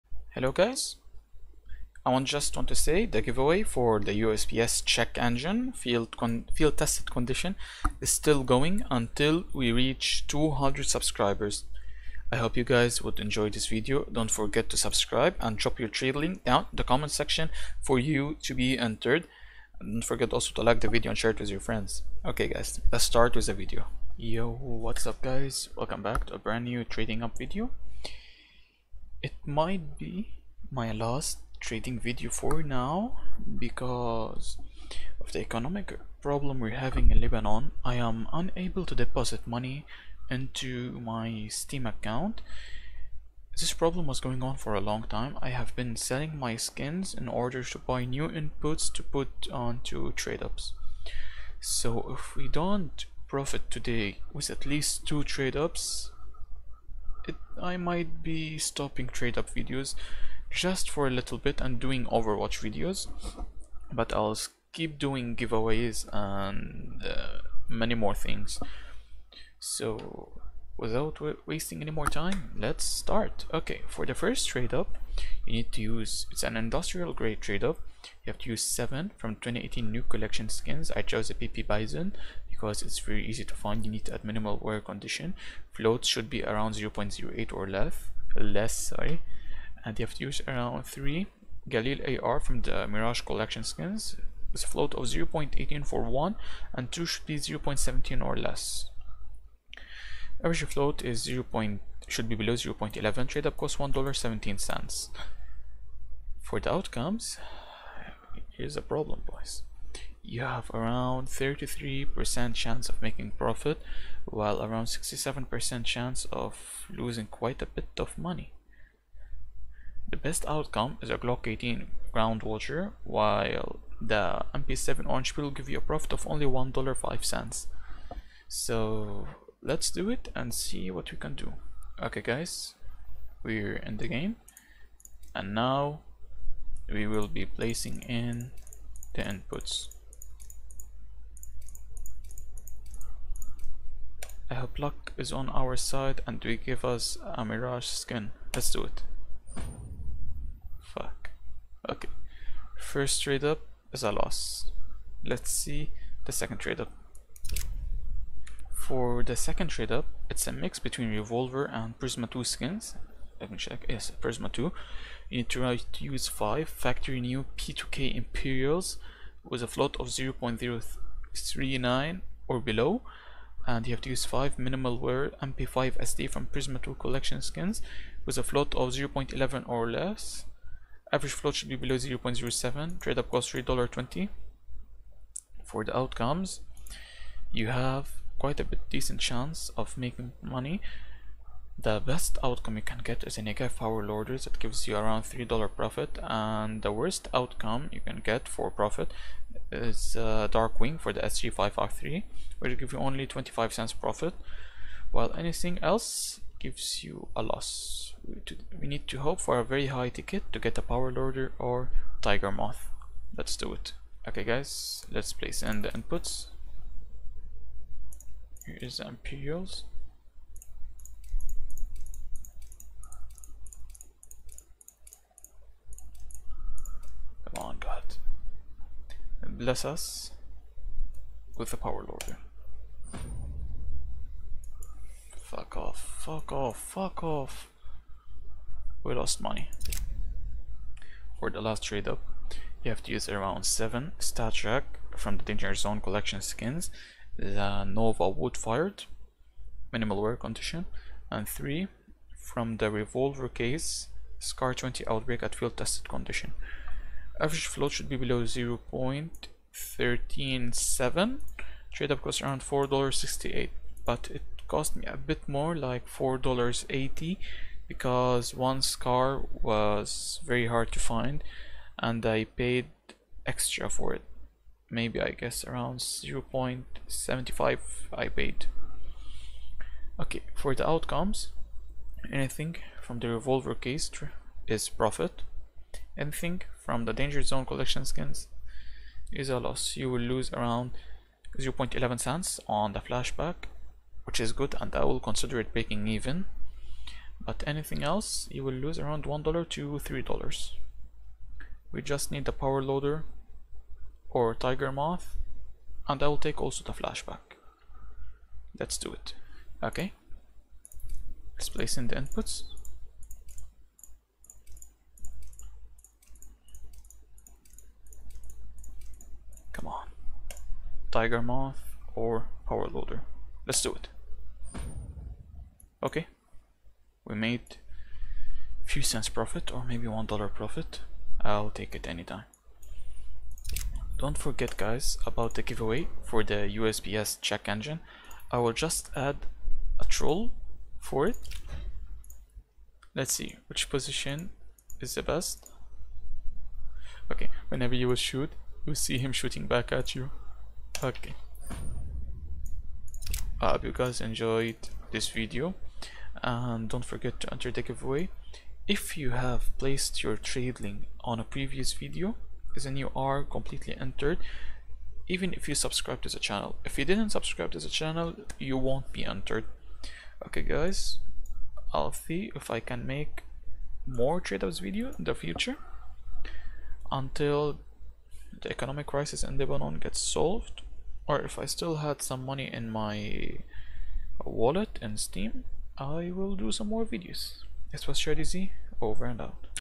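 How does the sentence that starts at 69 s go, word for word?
So without wasting any more time, let's start.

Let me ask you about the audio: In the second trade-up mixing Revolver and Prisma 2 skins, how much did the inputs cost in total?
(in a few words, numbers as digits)
$3.20.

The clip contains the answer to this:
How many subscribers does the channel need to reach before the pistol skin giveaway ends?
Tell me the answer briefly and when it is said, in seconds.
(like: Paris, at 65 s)
200, at 10 s.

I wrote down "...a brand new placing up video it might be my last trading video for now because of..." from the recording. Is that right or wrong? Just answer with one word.
wrong.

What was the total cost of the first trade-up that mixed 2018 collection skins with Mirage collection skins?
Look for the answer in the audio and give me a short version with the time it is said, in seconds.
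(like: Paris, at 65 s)
$1.17, at 103 s.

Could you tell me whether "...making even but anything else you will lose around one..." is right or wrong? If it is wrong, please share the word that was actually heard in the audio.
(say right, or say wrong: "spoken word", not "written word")
wrong: "breaking", not "making".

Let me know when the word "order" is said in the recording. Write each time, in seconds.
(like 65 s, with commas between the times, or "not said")
47 s, 194 s.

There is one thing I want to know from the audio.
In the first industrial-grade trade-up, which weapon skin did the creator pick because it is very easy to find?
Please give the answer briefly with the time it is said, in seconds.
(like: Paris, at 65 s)
PP Bison, at 81 s.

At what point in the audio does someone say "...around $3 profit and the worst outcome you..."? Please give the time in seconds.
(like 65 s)
194 s.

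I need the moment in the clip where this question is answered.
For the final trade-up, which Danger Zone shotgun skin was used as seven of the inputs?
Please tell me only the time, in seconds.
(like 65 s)
247 s.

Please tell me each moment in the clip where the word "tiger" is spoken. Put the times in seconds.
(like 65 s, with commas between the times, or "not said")
212 s, 304 s, 321 s.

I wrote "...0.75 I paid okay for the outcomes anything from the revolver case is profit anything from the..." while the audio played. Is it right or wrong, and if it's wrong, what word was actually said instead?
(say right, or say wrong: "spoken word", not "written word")
right.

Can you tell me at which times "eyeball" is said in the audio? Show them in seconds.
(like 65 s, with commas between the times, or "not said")
not said.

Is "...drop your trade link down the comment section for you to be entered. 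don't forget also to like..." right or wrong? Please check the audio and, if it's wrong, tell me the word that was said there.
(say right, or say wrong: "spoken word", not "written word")
right.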